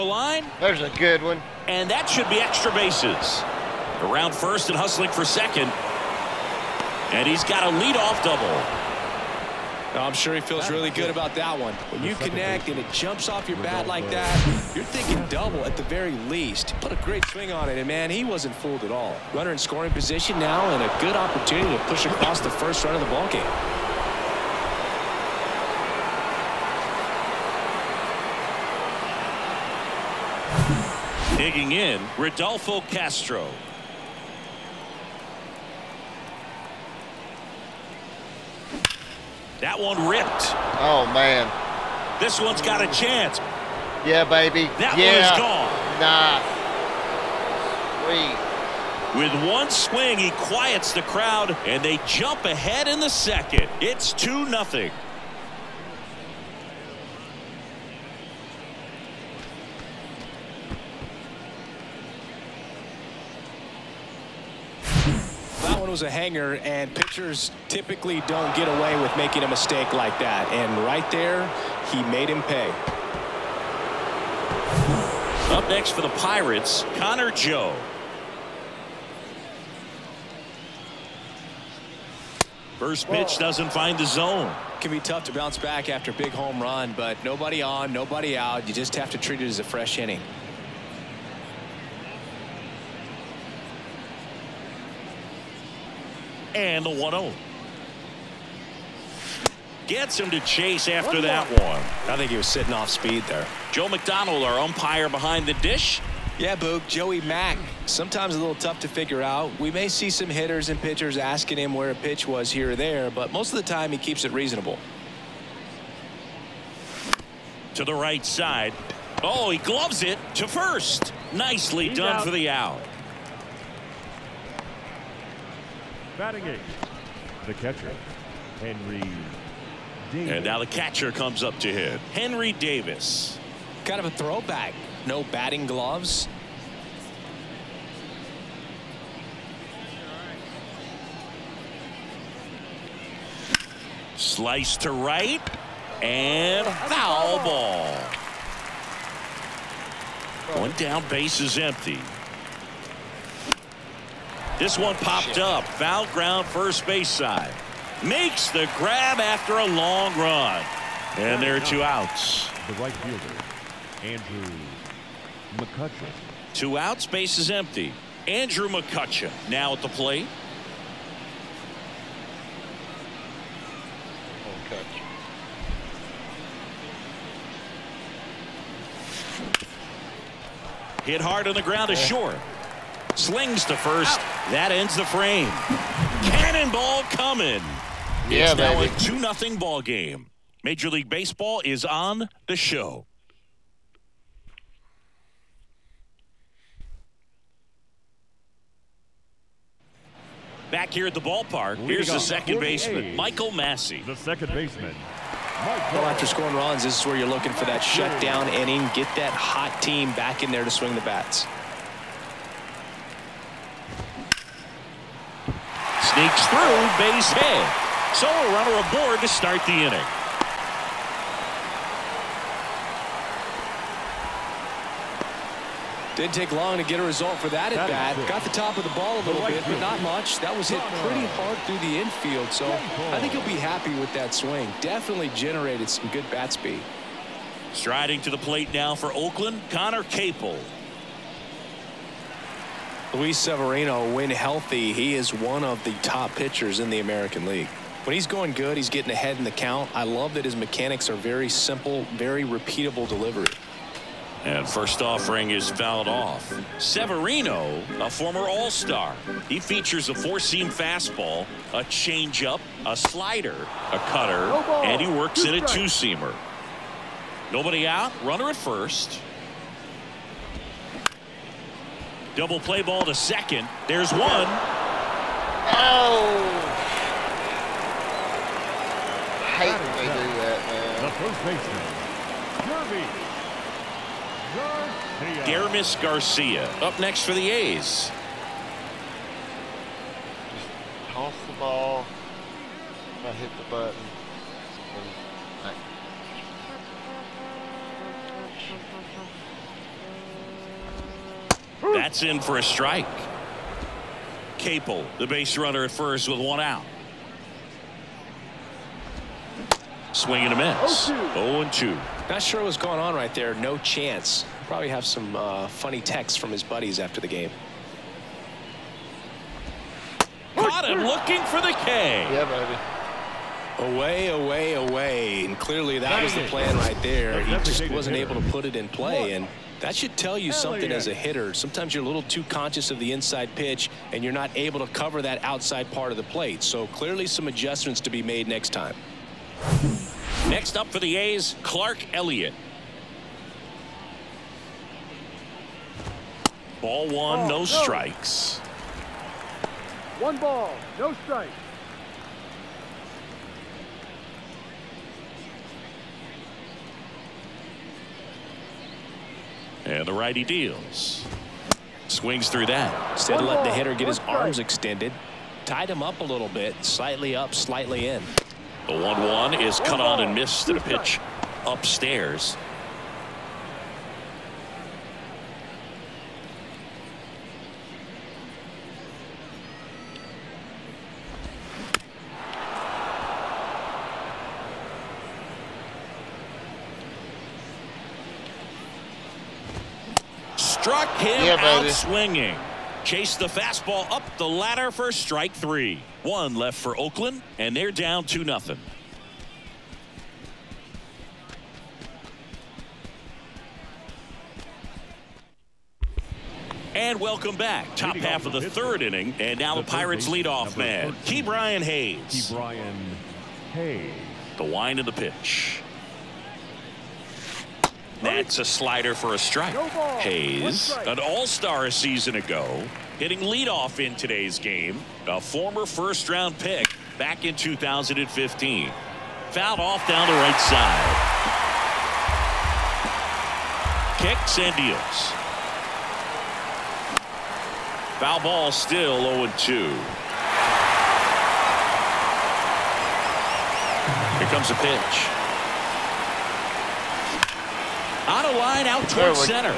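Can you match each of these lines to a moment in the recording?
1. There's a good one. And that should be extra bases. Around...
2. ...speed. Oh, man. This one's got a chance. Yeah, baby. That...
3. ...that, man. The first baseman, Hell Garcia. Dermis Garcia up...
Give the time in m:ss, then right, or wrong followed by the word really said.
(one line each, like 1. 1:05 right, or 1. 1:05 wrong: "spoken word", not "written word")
1. 0:00 right
2. 0:40 wrong: "ripped", not "speed"
3. 4:40 wrong: "Garvey", not "Hell".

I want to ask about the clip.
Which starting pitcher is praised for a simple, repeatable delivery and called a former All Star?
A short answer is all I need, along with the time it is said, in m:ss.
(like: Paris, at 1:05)
Luis Severino, at 4:03.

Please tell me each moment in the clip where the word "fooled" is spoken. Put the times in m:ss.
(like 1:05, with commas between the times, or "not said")
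0:18.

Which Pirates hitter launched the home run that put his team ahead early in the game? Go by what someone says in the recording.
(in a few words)
Rodolfo Castro.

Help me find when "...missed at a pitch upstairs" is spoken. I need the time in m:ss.
6:10.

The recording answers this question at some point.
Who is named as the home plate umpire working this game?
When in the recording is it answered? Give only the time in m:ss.
1:43.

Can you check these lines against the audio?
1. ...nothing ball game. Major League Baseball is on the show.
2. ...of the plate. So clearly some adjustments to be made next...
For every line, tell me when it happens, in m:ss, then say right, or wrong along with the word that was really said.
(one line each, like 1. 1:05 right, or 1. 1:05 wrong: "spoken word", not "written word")
1. 3:09 right
2. 5:36 right.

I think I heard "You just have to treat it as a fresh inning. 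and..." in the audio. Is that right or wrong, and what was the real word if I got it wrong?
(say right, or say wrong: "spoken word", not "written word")
right.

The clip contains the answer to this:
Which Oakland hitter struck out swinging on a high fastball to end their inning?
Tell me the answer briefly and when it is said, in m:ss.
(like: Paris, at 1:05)
Clark Elliott, at 5:41.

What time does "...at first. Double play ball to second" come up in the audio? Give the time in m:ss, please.
4:28.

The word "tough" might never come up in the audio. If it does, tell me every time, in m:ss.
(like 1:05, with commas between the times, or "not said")
1:25, 1:48.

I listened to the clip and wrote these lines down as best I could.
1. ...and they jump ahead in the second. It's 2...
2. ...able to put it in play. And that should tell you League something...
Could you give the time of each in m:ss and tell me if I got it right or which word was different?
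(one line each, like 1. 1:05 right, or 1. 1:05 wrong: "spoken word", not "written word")
1. 0:51 right
2. 5:28 wrong: "Hell", not "League".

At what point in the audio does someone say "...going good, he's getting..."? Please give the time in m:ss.
4:08.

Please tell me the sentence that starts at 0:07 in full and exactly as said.
And he's got a leadoff double.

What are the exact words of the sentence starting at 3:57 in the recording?
Striding to the plate now for Oakland, Conner Capel.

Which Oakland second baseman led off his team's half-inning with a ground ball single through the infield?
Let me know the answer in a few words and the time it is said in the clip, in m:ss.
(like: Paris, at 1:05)
Michael Massey, at 3:23.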